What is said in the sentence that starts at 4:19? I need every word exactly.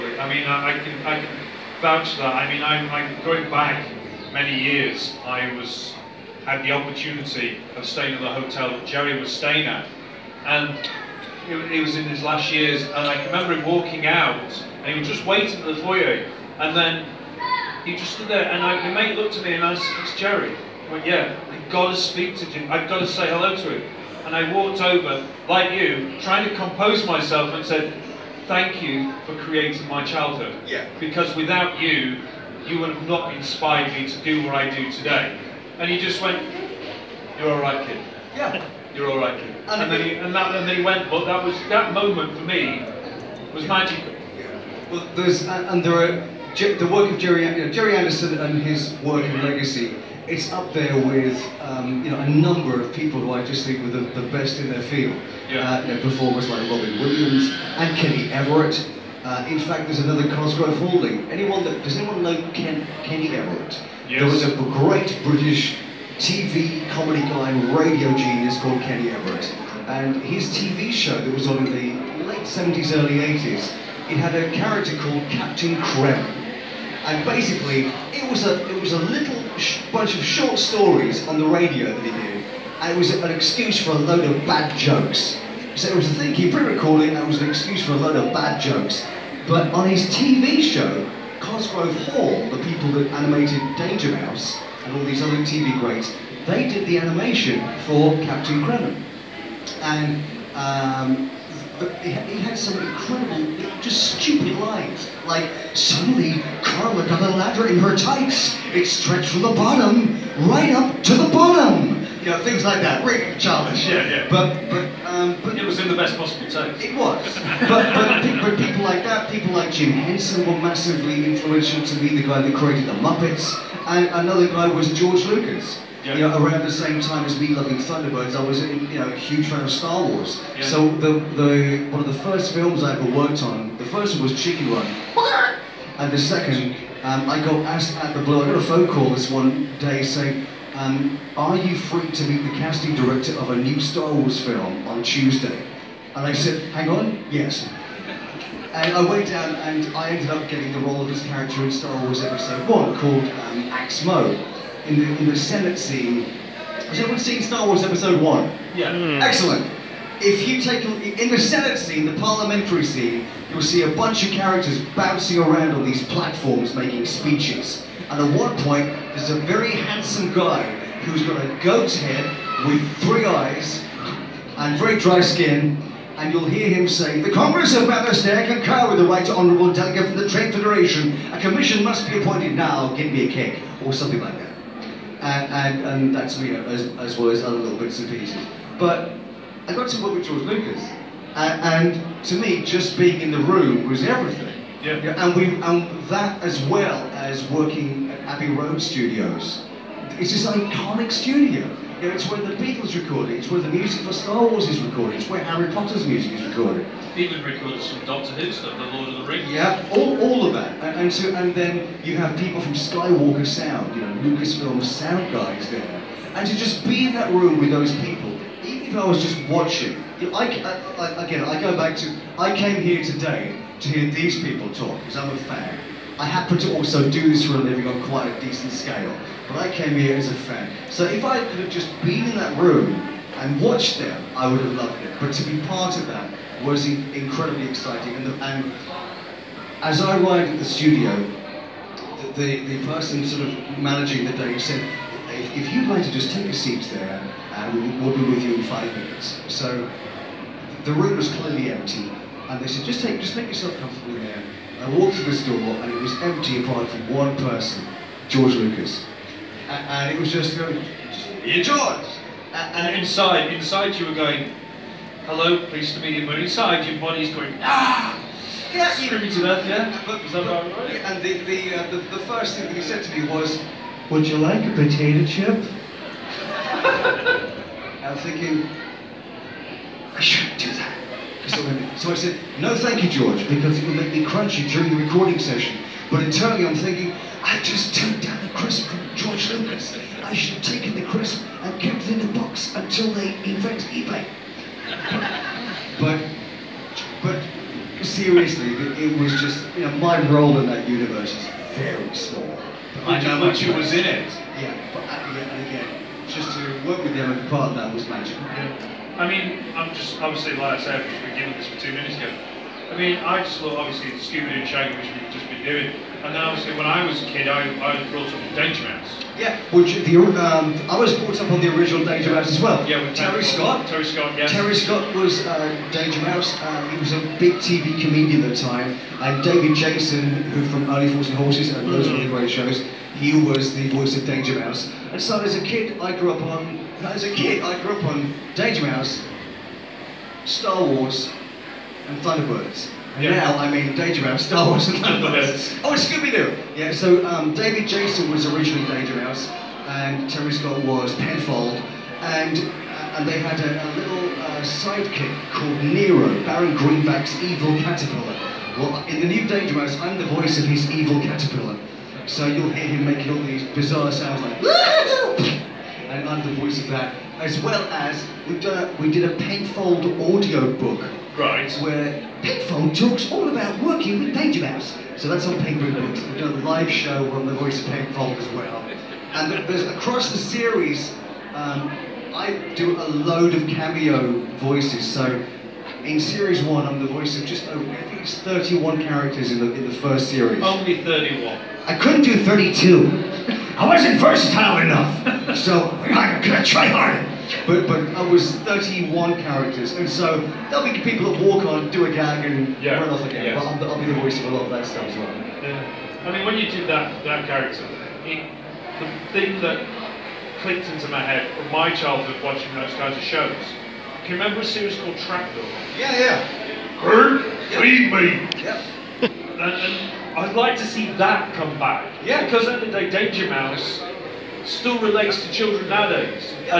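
And, and it was just going, here, George!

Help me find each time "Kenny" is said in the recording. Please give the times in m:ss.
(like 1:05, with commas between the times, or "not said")
0:57, 1:03, 1:08.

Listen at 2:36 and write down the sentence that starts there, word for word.
Has anyone seen Star Wars Episode 1?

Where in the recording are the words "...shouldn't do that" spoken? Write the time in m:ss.
4:40.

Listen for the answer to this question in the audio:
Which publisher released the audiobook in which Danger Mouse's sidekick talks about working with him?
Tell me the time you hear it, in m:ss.
6:15.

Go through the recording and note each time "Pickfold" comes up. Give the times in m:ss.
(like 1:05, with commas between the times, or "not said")
6:12, 6:17.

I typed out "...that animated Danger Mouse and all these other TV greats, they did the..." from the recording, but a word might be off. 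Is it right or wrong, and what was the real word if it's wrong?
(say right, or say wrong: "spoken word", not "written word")
right.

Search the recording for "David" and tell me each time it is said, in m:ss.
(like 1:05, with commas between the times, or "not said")
5:29, 5:47.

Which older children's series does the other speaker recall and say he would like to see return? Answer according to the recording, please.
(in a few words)
Trapdoor.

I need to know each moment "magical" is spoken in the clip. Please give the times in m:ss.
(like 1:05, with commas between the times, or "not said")
0:43, 5:08.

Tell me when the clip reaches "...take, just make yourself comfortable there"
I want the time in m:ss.
4:13.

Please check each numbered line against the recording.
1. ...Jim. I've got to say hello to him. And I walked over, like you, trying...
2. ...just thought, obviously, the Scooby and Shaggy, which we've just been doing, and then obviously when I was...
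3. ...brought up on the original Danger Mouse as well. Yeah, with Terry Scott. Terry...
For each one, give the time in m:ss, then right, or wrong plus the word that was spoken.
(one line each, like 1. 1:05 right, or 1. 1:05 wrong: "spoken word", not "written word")
1. 0:22 right
2. 5:13 right
3. 5:21 right.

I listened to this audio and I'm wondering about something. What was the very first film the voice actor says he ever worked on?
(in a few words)
Chicken Run.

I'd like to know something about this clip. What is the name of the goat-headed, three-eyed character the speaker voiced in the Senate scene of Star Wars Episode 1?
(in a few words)
Aks Moe.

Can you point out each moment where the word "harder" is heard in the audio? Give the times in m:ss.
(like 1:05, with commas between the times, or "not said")
6:36.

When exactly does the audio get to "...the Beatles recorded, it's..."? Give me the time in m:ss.
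3:22.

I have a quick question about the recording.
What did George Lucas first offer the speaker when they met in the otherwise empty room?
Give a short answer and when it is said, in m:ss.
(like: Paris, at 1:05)
A potato chip, at 4:34.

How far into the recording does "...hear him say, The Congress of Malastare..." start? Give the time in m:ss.
2:56.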